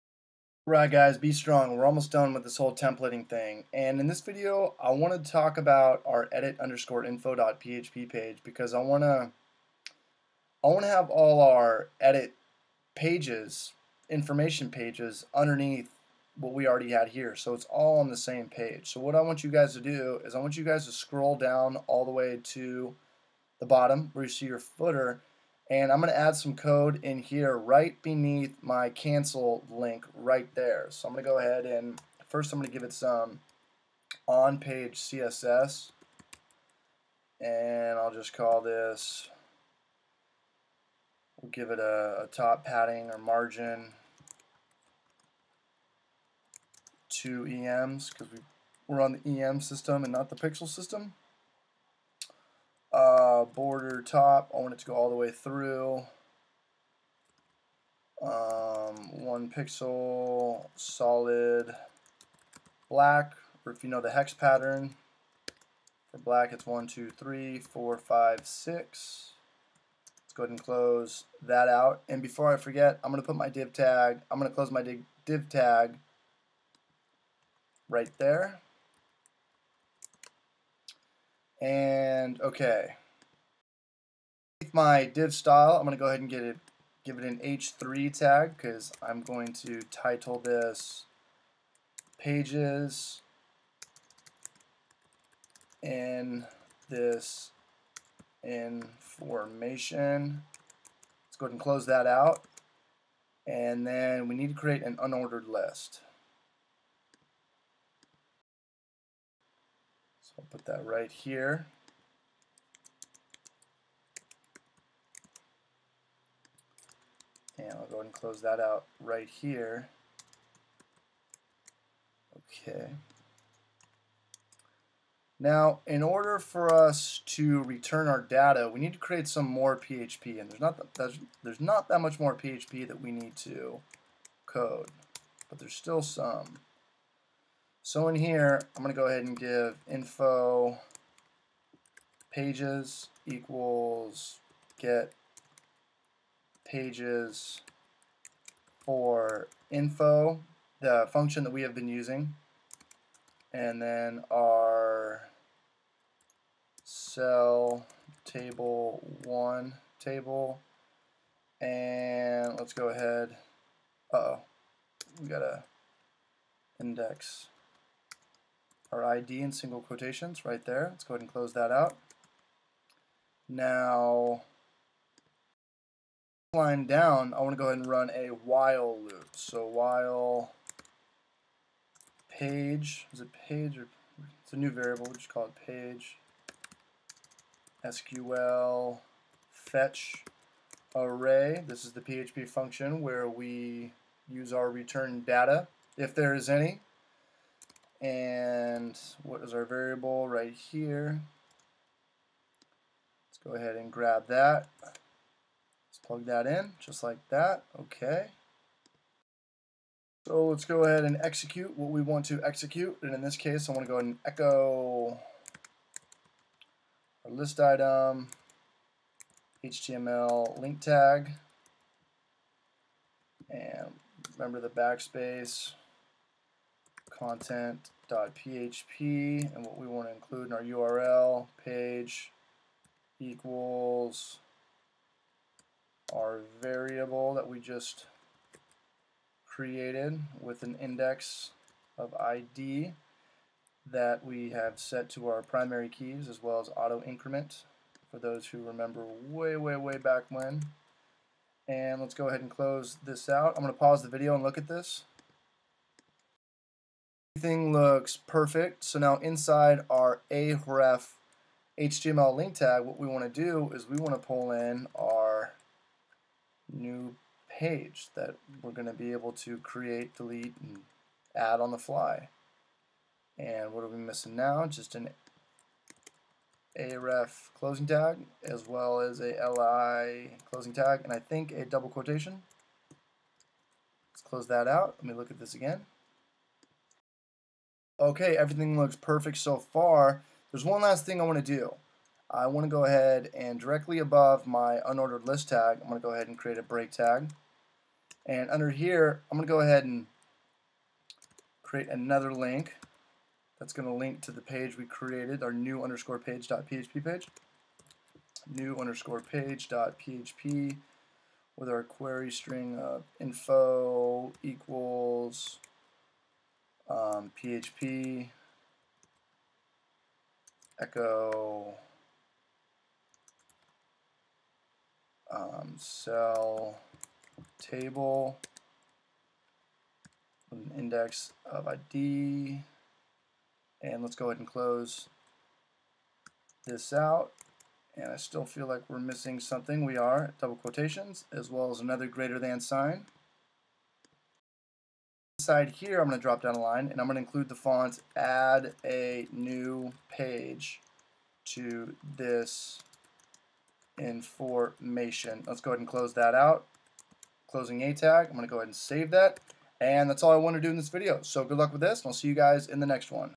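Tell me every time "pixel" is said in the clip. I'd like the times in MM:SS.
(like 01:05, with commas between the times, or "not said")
00:50, 00:59.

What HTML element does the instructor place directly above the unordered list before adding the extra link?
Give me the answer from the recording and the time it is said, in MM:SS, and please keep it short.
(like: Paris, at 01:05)
break tag, at 04:56.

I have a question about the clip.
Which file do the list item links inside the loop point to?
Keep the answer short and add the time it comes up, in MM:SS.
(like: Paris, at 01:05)
content.php, at 03:47.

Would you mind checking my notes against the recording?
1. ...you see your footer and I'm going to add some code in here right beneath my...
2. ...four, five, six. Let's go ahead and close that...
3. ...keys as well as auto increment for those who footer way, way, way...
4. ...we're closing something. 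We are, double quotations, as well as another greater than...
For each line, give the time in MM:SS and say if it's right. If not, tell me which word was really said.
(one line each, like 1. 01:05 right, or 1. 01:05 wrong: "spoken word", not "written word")
1. 00:24 right
2. 01:07 right
3. 04:05 wrong: "remember", not "footer"
4. 05:38 wrong: "missing", not "closing".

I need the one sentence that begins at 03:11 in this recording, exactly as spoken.
This is the PHP function where we use our return data, if there is any.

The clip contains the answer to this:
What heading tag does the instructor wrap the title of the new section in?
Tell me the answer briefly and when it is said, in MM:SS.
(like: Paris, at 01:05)
h3, at 01:27.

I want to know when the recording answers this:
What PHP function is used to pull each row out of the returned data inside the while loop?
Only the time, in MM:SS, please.
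03:07.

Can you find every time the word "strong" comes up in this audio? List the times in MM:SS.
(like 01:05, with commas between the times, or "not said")
00:01.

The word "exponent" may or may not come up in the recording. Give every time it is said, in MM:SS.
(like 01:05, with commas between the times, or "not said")
not said.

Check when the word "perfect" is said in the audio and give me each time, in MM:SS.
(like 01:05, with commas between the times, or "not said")
04:18, 04:48.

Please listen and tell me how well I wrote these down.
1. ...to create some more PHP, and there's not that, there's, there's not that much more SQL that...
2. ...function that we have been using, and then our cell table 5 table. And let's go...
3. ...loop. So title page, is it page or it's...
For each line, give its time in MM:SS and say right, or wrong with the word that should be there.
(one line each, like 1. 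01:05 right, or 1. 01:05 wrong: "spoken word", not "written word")
1. 02:08 wrong: "PHP", not "SQL"
2. 02:31 wrong: "1", not "5"
3. 02:59 wrong: "while", not "title".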